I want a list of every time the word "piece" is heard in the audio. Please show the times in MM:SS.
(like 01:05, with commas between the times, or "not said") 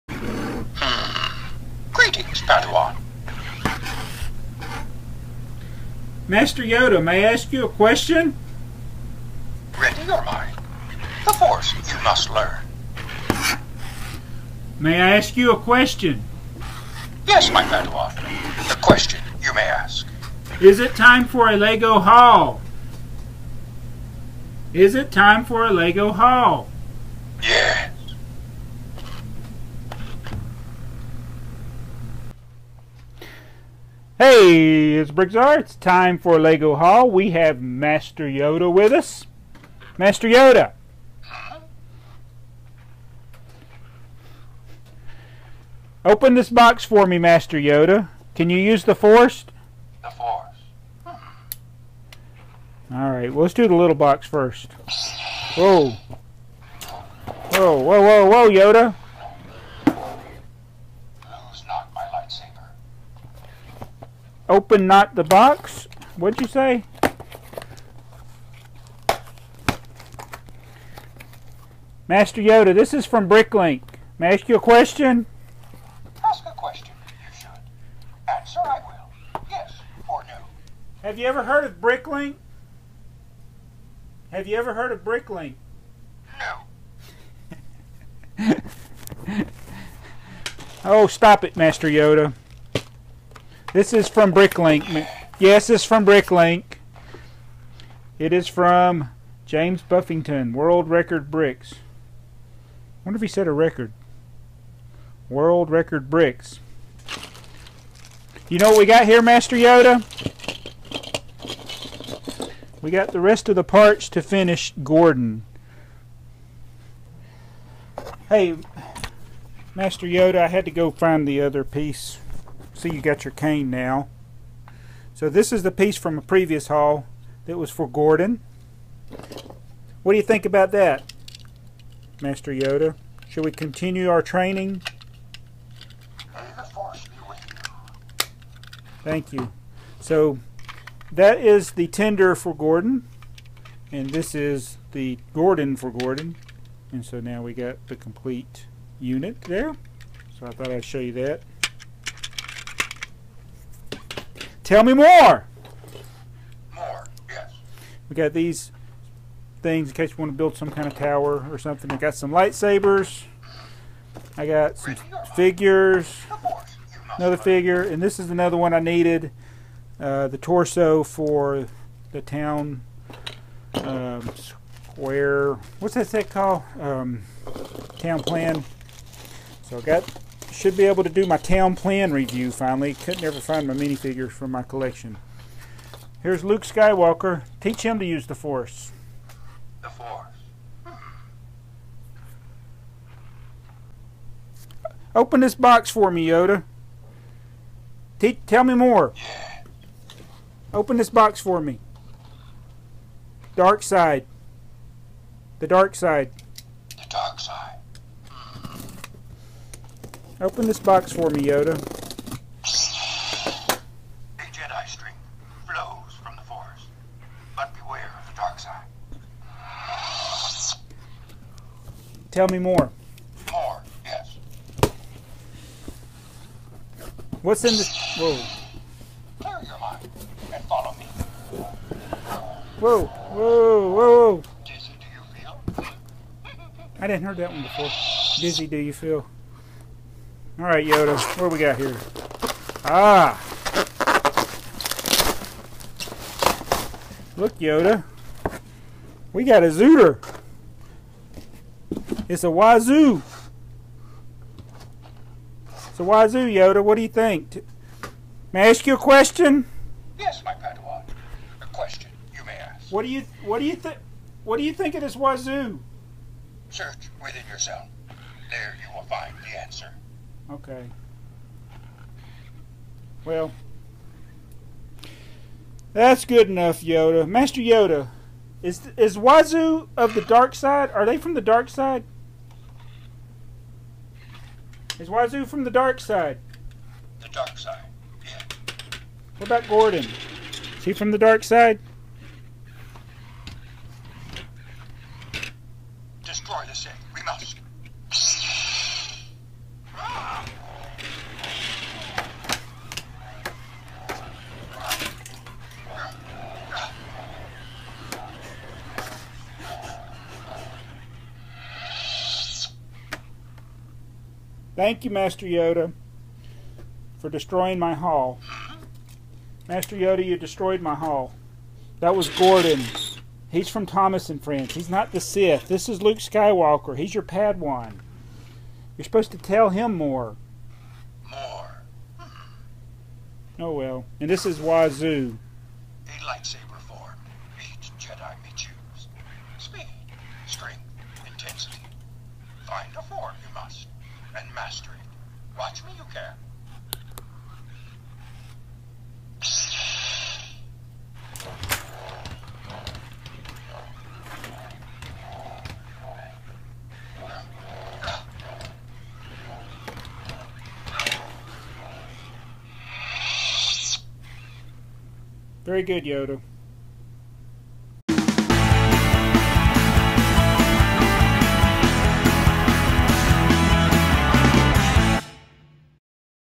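02:01, 02:05.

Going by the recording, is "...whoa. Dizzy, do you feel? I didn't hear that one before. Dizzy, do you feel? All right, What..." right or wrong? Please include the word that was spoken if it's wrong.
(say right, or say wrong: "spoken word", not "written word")
wrong: "Yoda", not "What".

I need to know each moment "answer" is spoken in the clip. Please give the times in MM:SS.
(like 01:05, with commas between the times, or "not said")
01:18, 04:29.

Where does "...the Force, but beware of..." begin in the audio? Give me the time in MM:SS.
03:36.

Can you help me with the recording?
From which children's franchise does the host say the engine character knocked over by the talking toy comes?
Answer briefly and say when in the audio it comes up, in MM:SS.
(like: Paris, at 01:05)
Thomas and Friends, at 05:23.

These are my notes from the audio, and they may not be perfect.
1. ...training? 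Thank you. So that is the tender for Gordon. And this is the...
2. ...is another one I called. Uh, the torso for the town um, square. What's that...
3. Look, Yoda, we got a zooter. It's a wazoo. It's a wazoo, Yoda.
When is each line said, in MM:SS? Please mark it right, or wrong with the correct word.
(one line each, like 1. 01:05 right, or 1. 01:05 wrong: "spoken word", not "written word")
1. 02:14 right
2. 02:48 wrong: "needed", not "called"
3. 04:07 right.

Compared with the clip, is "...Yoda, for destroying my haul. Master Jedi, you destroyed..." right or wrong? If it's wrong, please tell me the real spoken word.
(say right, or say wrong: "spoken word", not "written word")
wrong: "Yoda", not "Jedi".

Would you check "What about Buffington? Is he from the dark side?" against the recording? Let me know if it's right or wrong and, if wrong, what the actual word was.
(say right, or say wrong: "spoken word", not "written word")
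wrong: "Gordon", not "Buffington".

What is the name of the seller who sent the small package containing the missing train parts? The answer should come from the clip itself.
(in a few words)
James Buffington.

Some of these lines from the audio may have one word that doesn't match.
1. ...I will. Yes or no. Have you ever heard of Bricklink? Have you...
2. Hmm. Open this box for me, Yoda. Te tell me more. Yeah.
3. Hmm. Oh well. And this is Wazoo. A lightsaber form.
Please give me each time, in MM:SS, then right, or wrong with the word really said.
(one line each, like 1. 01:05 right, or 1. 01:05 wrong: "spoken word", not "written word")
1. 01:18 right
2. 03:10 right
3. 05:32 right.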